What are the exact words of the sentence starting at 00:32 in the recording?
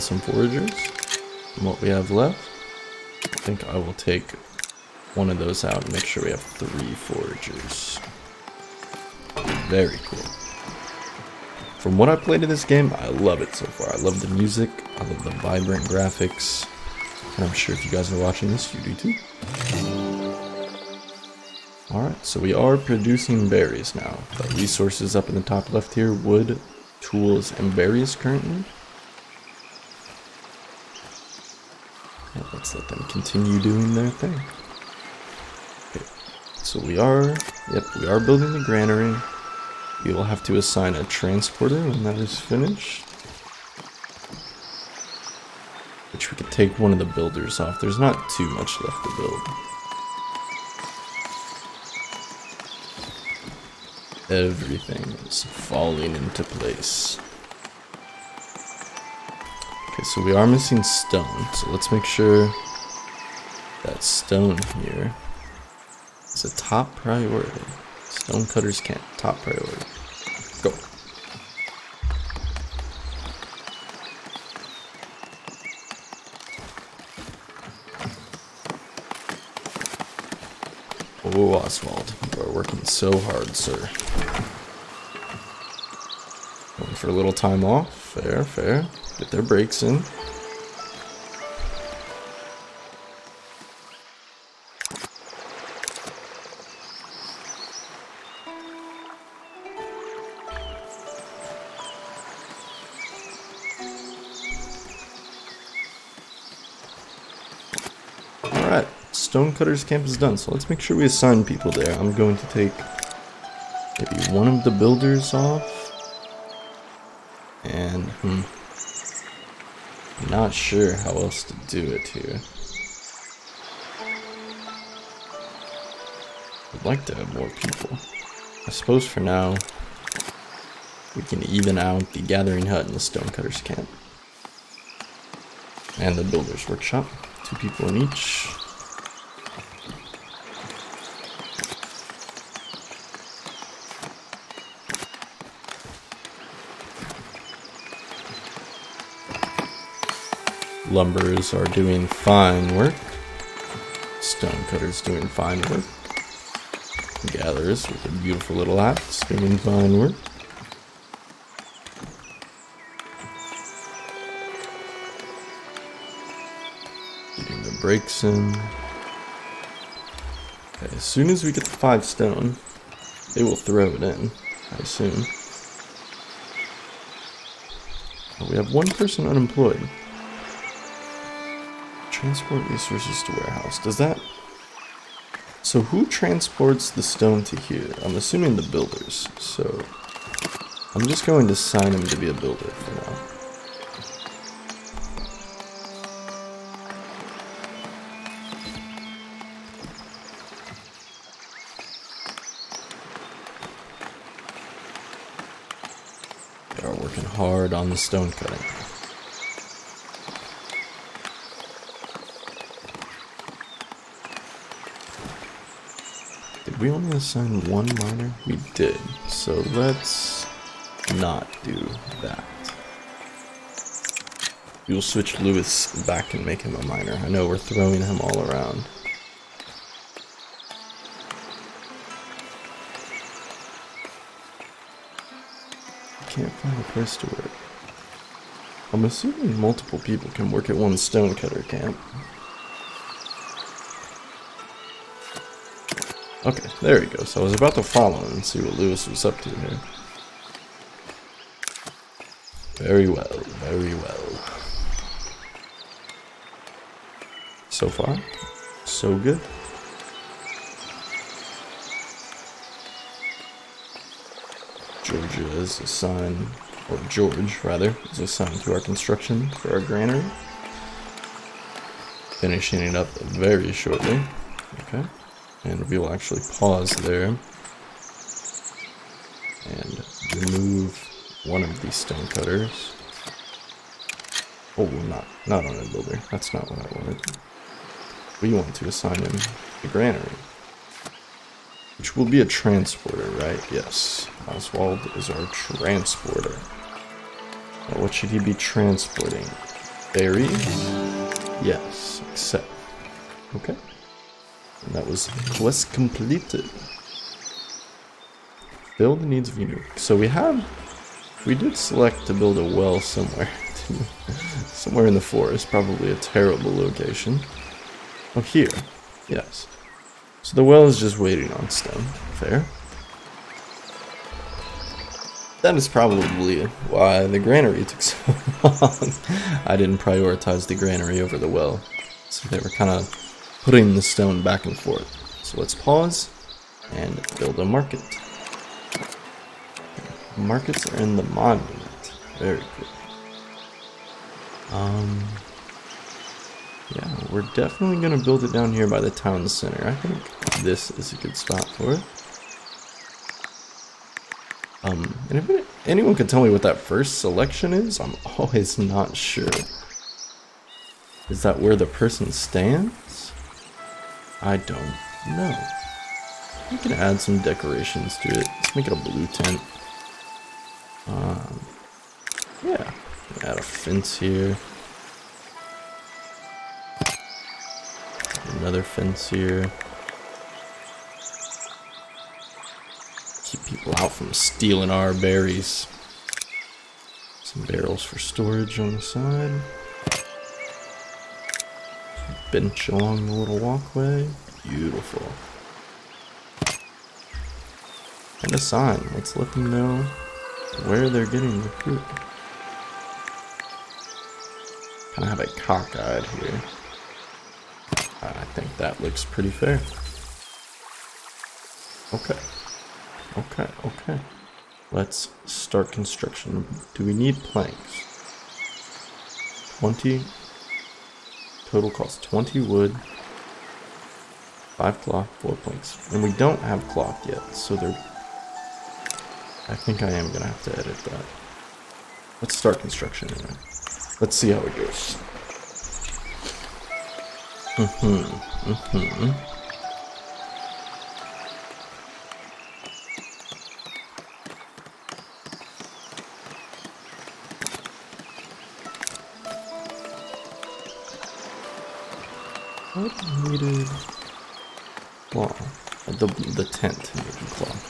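And let's let them continue doing their thing.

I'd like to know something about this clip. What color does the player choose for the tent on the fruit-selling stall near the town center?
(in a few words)
Blue.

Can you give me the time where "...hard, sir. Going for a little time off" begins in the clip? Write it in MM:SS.
01:23.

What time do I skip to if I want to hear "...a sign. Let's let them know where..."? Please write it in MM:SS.
06:38.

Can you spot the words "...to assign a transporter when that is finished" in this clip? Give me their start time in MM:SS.
00:40.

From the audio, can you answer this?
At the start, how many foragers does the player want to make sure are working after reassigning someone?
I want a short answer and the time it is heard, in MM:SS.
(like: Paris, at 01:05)
3, at 00:06.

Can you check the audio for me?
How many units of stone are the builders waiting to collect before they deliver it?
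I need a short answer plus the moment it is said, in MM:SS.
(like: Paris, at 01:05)
5, at 02:51.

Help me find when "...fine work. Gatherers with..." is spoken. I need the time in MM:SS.
02:35.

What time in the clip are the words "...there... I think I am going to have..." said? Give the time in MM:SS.
07:07.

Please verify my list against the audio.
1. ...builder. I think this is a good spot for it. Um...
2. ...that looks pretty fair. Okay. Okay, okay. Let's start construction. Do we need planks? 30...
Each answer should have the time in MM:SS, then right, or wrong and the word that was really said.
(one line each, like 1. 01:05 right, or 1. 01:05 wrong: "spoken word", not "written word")
1. 05:49 wrong: "center", not "builder"
2. 06:48 wrong: "20", not "30".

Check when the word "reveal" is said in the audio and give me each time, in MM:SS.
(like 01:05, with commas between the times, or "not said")
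not said.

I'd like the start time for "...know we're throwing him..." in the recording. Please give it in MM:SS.
03:47.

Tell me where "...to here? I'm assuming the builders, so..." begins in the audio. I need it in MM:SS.
03:07.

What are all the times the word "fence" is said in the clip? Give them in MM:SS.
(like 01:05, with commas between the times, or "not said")
06:13, 06:18.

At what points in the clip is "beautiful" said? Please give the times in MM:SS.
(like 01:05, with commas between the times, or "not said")
02:38, 06:34.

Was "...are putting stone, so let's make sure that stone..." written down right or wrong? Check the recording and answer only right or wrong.
wrong.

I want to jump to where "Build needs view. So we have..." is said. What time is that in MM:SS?
05:08.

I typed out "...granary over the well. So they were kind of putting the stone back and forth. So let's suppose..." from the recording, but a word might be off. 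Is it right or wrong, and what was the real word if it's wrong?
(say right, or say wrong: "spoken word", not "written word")
wrong: "pause", not "suppose".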